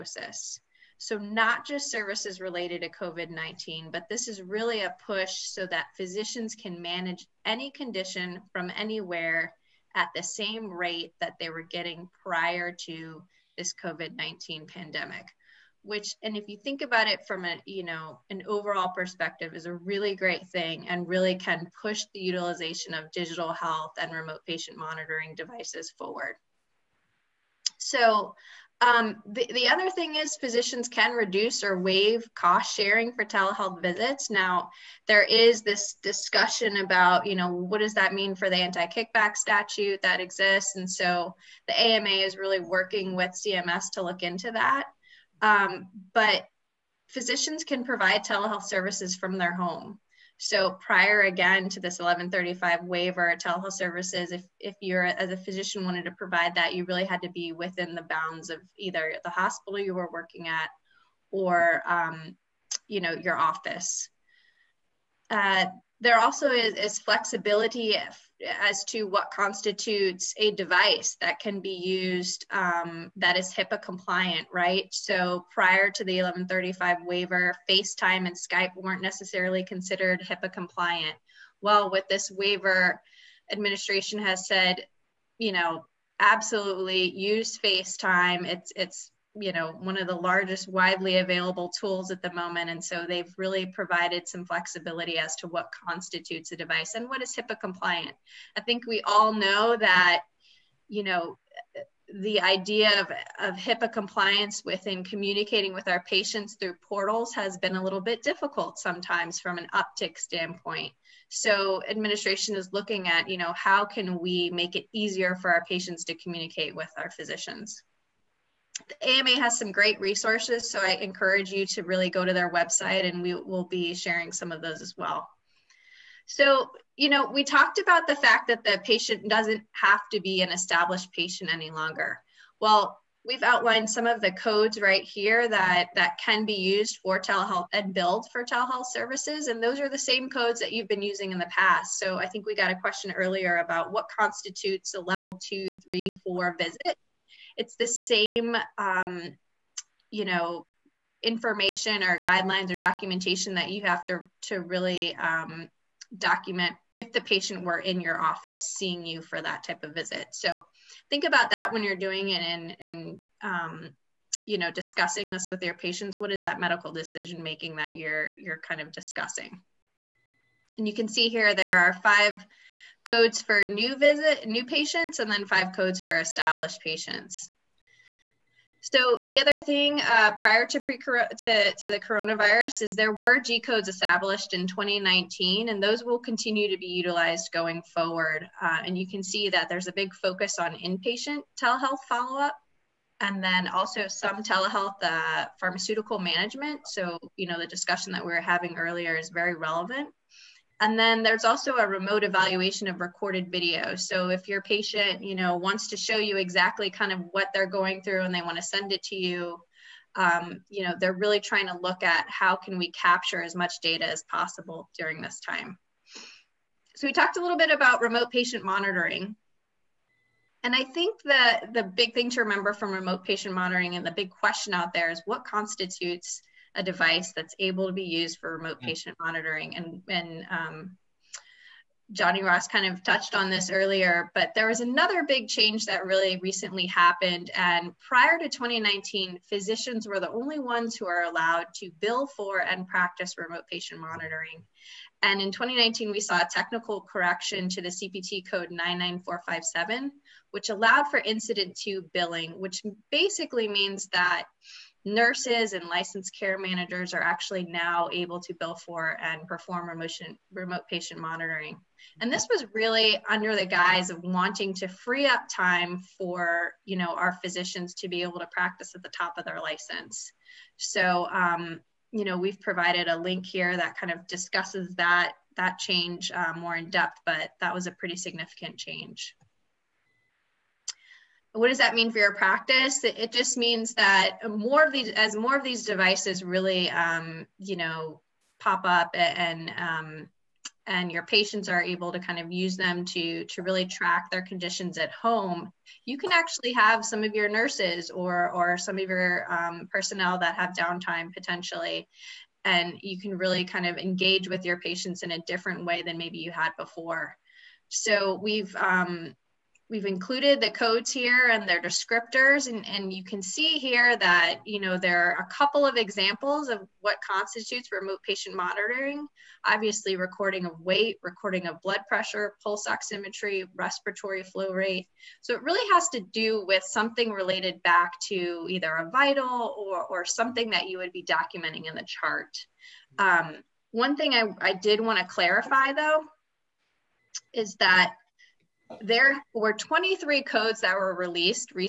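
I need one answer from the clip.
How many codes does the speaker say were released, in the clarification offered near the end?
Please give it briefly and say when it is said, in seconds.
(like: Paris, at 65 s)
23, at 339 s.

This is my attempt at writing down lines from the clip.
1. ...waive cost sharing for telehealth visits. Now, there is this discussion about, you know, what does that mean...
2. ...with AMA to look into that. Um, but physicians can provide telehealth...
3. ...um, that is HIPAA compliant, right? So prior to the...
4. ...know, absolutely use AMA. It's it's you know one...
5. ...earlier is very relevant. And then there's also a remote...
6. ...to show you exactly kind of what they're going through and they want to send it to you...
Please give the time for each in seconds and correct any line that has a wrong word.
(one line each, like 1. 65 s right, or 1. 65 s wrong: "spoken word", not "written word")
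1. 31 s right
2. 43 s wrong: "CMS", not "AMA"
3. 72 s right
4. 85 s wrong: "FaceTime", not "AMA"
5. 198 s right
6. 205 s right.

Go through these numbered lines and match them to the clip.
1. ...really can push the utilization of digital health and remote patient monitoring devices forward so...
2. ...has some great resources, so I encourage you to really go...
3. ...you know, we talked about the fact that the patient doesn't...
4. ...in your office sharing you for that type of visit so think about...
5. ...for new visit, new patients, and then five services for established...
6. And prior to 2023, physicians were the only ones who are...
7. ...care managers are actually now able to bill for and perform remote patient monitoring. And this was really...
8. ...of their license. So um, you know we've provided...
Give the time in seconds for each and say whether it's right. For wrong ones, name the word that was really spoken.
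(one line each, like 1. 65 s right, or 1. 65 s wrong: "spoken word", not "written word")
1. 21 s right
2. 119 s right
3. 126 s right
4. 157 s wrong: "seeing", not "sharing"
5. 173 s wrong: "codes", not "services"
6. 237 s wrong: "2019", not "2023"
7. 256 s right
8. 269 s right.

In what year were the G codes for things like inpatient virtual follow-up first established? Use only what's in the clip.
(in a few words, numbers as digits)
2019.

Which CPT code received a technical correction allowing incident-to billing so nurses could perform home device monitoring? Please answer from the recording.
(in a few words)
99457.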